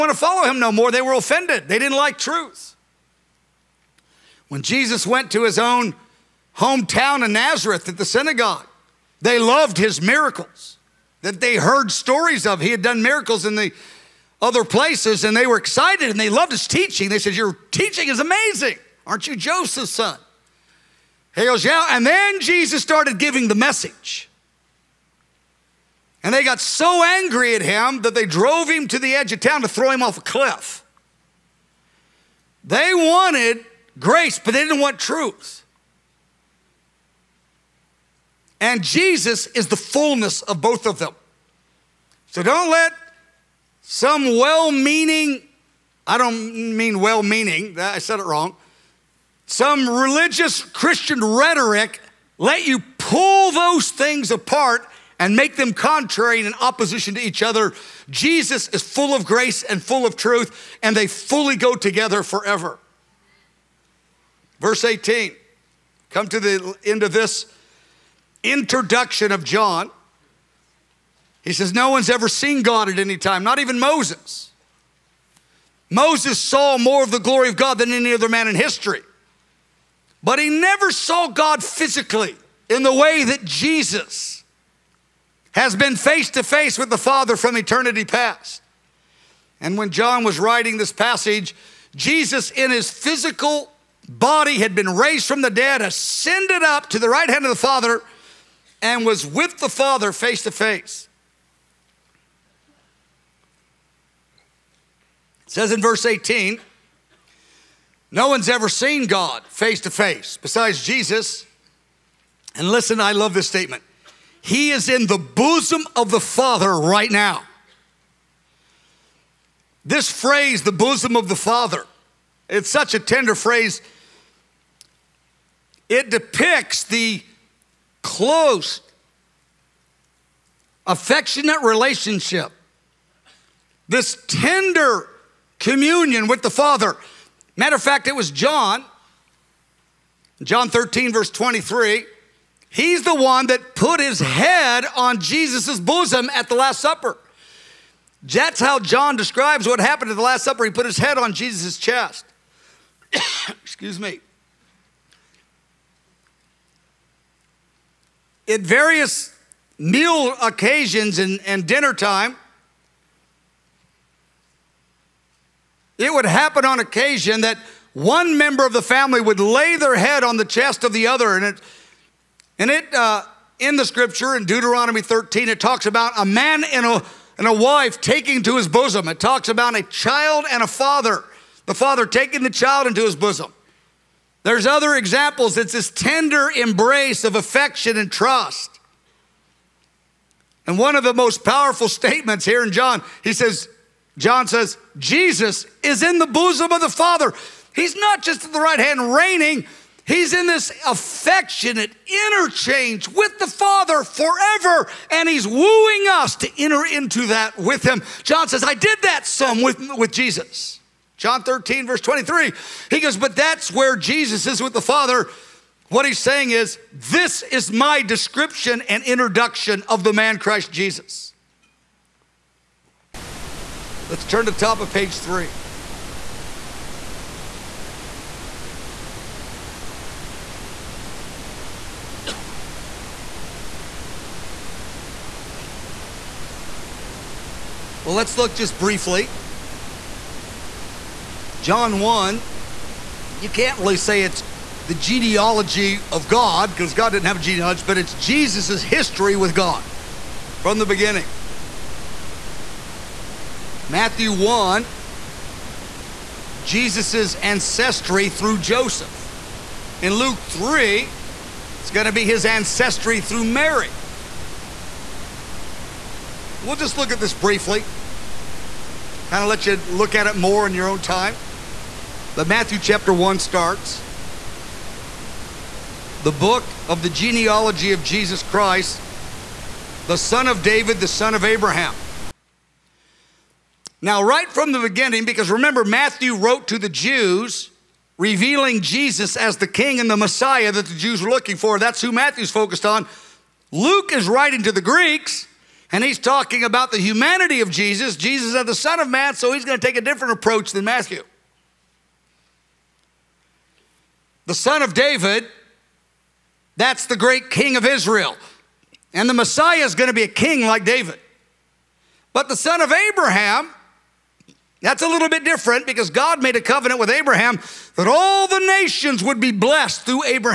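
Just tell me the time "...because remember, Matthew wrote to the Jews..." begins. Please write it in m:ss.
4:45.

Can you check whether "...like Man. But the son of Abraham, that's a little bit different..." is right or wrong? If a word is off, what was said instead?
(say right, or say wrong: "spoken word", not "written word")
wrong: "David", not "Man".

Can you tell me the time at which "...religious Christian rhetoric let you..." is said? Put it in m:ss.
0:49.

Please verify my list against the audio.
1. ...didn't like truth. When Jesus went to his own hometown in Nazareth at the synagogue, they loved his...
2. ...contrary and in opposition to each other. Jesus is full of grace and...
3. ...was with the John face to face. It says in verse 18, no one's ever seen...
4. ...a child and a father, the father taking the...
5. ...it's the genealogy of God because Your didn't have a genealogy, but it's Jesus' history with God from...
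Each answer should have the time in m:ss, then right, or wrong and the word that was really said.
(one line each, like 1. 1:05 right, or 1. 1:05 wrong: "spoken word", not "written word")
1. 0:01 right
2. 0:55 right
3. 1:39 wrong: "Father", not "John"
4. 2:59 right
5. 4:04 wrong: "God", not "Your".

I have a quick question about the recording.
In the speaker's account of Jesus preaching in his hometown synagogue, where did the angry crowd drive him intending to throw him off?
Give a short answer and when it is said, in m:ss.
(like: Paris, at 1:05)
A cliff, at 0:30.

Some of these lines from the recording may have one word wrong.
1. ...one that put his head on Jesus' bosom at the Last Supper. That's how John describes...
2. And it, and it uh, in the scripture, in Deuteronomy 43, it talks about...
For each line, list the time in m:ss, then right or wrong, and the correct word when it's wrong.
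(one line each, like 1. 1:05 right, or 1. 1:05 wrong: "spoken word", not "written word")
1. 2:23 right
2. 2:51 wrong: "13", not "43".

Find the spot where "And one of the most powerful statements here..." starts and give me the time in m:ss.
3:10.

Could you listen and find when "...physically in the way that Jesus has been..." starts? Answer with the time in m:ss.
1:21.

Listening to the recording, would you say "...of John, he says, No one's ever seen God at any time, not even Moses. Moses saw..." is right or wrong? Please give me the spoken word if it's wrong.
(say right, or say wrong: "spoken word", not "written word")
right.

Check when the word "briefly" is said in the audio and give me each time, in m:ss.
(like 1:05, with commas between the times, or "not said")
3:58, 4:27.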